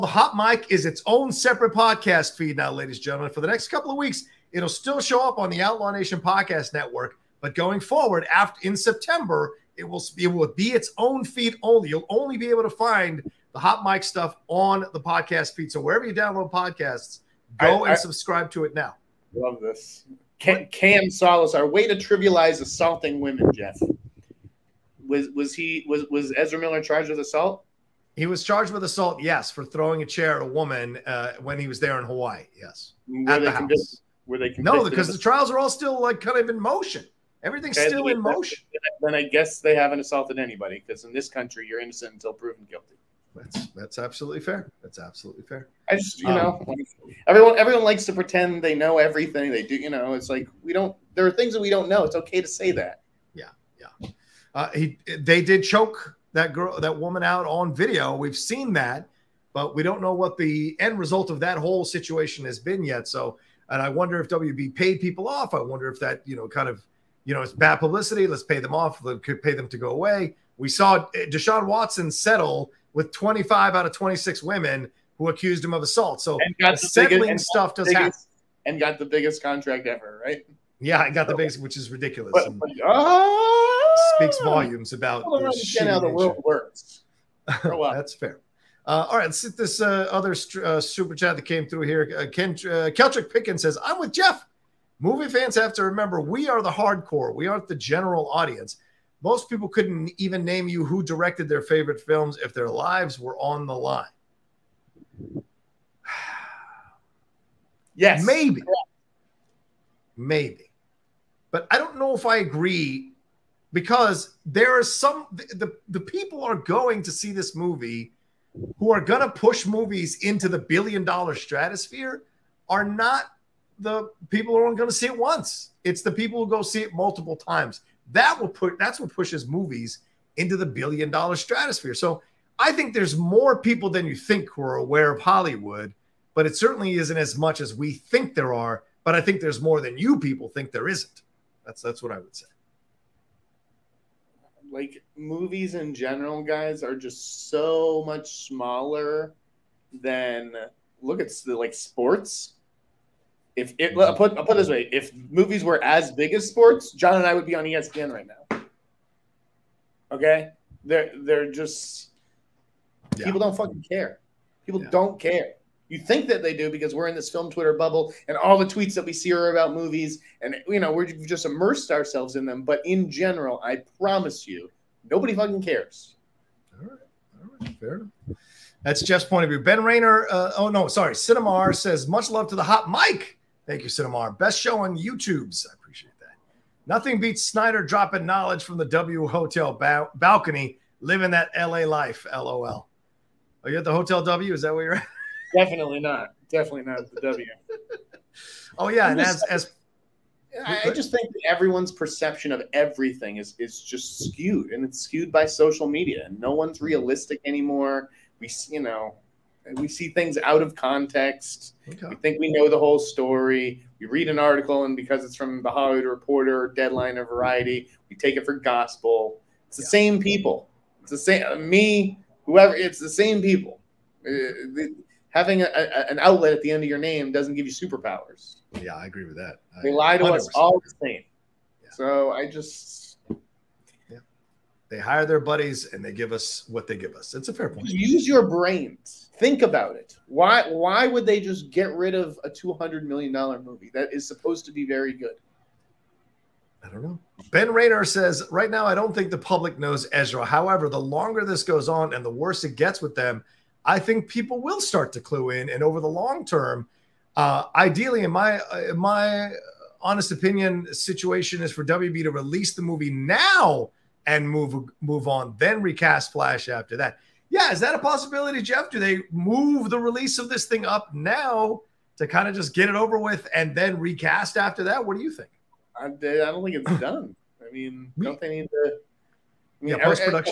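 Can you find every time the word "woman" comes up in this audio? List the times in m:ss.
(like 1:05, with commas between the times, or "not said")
0:30, 0:56.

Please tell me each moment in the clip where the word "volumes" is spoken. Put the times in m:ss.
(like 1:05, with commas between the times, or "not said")
1:24.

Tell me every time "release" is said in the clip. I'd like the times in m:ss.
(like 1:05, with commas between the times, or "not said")
4:22, 4:29.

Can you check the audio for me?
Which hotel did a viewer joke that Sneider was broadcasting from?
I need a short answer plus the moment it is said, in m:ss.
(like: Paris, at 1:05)
W Hotel, at 3:08.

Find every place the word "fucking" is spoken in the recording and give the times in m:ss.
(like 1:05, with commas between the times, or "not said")
2:43, 2:55.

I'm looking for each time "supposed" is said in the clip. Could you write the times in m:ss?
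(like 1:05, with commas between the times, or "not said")
4:04.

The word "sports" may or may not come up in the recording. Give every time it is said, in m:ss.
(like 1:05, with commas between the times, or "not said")
2:31, 2:36.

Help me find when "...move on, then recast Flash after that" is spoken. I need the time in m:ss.
4:25.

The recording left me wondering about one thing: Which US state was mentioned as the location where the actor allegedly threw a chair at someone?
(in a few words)
Hawaii.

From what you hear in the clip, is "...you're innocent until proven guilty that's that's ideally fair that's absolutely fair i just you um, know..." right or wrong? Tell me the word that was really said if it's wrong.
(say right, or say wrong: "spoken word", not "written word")
wrong: "absolutely", not "ideally".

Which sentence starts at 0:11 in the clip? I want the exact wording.
You'll only be able to find the Hot Mic stuff on the podcast feed.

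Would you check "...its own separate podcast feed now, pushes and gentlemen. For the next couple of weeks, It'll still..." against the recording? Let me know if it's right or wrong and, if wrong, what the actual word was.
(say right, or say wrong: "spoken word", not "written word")
wrong: "ladies", not "pushes".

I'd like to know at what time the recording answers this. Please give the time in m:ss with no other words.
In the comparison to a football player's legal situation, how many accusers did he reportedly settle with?
1:13.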